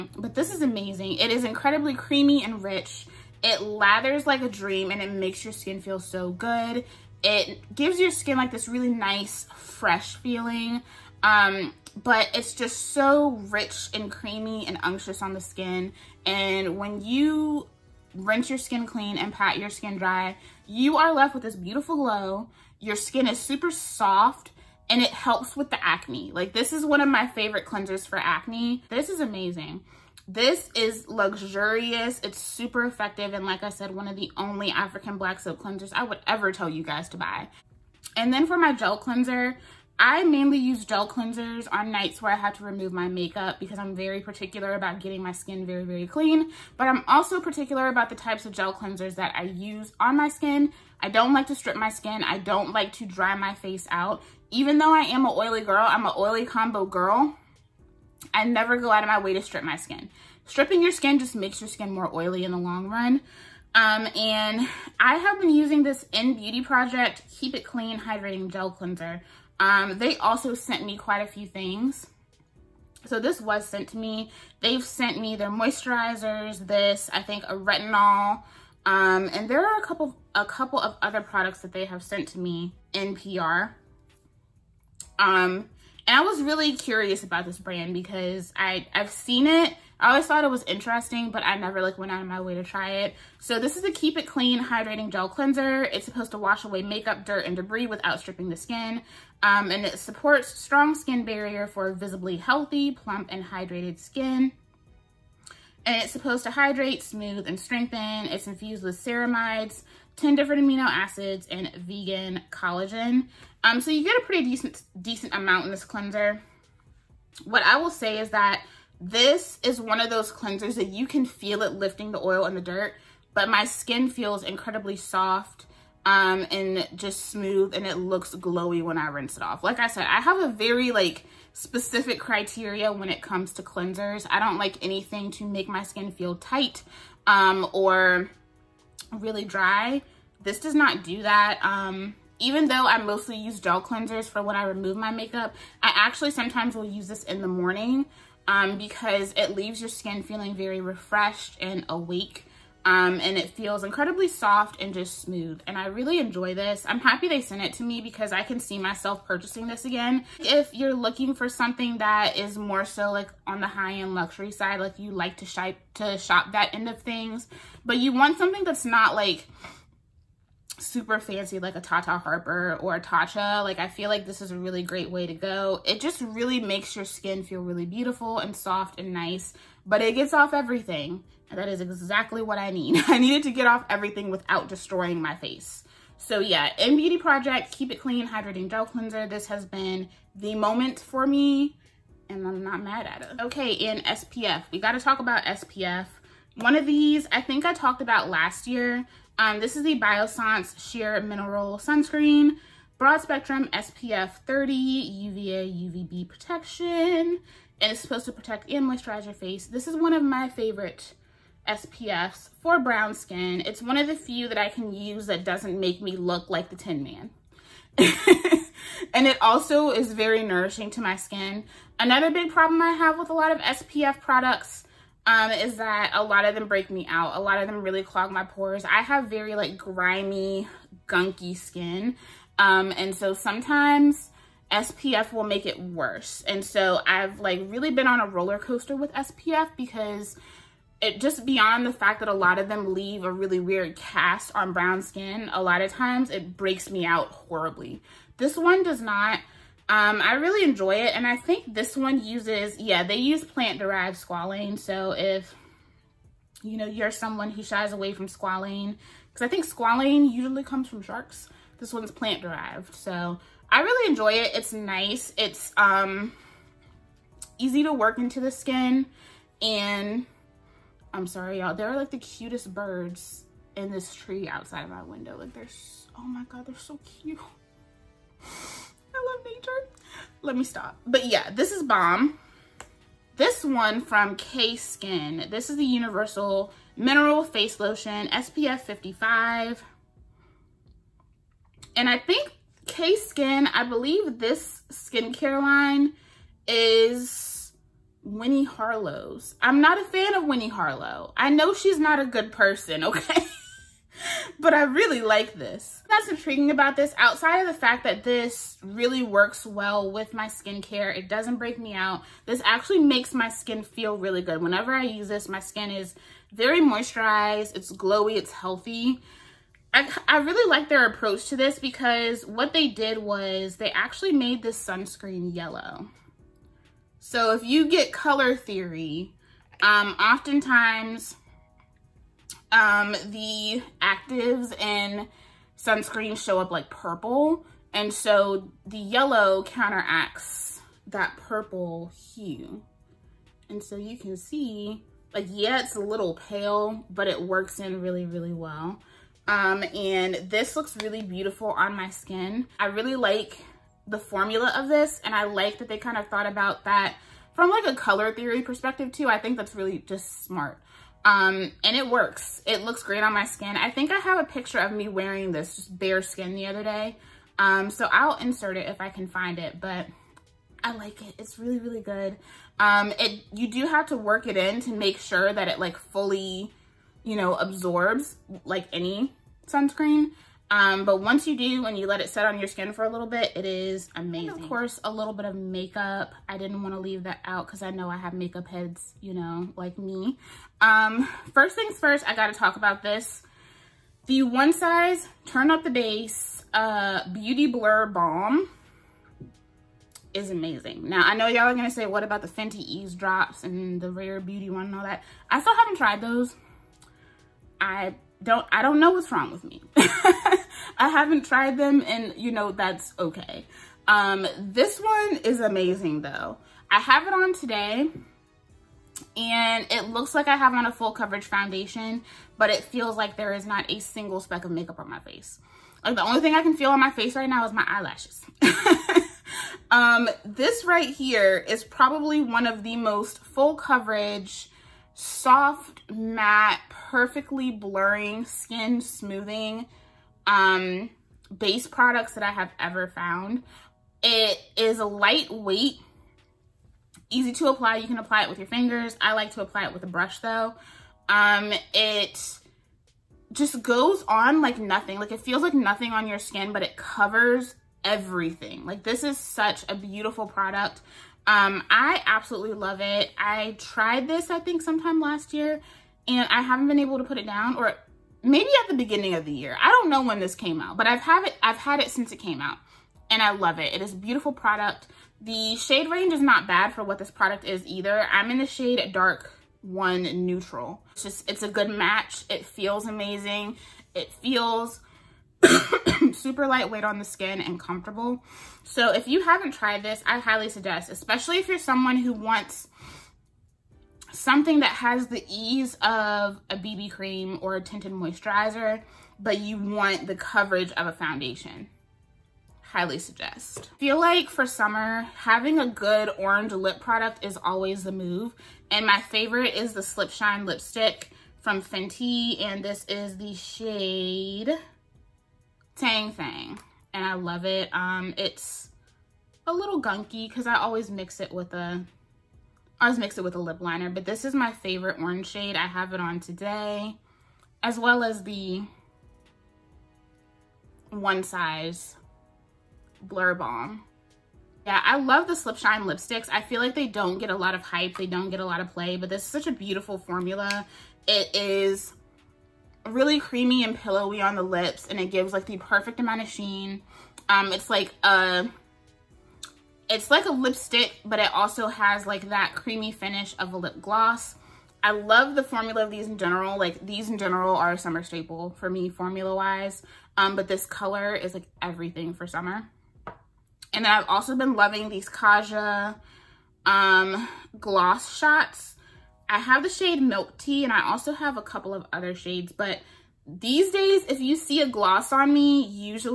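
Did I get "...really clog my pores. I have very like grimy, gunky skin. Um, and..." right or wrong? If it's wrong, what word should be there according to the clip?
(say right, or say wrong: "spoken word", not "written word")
right.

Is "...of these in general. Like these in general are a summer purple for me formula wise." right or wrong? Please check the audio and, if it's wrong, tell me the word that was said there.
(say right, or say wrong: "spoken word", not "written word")
wrong: "staple", not "purple".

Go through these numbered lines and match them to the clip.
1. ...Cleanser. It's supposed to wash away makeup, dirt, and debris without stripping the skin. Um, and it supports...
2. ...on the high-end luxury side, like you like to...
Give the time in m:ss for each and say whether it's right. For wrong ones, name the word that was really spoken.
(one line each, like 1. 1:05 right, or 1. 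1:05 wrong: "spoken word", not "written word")
1. 1:35 right
2. 2:43 right.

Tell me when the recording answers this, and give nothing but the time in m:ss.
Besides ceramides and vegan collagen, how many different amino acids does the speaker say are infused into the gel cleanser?
1:50.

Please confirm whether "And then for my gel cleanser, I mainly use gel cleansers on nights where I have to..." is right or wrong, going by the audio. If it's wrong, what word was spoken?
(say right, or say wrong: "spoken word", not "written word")
right.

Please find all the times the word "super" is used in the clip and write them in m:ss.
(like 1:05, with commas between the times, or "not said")
0:23, 0:32, 2:50, 8:06.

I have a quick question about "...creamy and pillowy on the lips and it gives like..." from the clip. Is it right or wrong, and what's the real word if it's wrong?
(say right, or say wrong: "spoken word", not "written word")
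right.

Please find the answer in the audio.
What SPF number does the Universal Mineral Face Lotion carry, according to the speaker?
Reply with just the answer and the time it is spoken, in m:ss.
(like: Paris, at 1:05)
SPF 55, at 4:48.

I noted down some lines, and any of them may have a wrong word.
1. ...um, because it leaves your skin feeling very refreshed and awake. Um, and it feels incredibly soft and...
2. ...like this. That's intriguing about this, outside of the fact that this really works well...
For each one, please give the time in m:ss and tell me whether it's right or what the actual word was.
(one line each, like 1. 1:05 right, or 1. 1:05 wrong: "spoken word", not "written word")
1. 2:28 right
2. 5:05 right.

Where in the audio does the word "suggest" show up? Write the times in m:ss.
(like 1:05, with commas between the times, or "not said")
8:10, 8:23.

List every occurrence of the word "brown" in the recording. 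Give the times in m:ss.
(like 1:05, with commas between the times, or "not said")
3:32, 4:04.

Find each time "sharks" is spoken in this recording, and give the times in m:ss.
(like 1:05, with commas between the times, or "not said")
4:21.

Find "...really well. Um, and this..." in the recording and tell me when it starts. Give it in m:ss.
5:48.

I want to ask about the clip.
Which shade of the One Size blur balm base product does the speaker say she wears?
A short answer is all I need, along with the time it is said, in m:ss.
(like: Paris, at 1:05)
dark one neutral, at 7:59.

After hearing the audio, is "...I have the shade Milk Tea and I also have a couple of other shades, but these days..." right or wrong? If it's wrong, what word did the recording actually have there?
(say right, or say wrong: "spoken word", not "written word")
right.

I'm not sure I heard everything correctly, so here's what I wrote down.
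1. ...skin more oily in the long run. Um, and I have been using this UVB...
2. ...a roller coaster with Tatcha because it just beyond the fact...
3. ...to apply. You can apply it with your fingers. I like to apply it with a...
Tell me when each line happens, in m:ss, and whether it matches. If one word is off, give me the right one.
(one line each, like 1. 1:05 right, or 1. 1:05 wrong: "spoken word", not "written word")
1. 1:01 wrong: "INNBEAUTY", not "UVB"
2. 3:58 wrong: "SPF", not "Tatcha"
3. 7:27 right.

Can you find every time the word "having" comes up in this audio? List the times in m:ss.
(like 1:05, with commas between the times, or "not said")
8:25.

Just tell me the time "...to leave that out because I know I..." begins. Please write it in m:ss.
6:26.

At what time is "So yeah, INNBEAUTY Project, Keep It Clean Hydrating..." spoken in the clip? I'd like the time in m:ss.
3:06.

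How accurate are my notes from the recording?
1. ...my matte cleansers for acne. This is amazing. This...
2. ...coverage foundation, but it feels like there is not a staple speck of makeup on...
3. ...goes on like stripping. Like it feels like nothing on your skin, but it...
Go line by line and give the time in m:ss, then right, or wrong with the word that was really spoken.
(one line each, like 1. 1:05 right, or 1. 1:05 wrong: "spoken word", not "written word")
1. 0:27 wrong: "favorite", not "matte"
2. 7:01 wrong: "single", not "staple"
3. 7:33 wrong: "nothing", not "stripping".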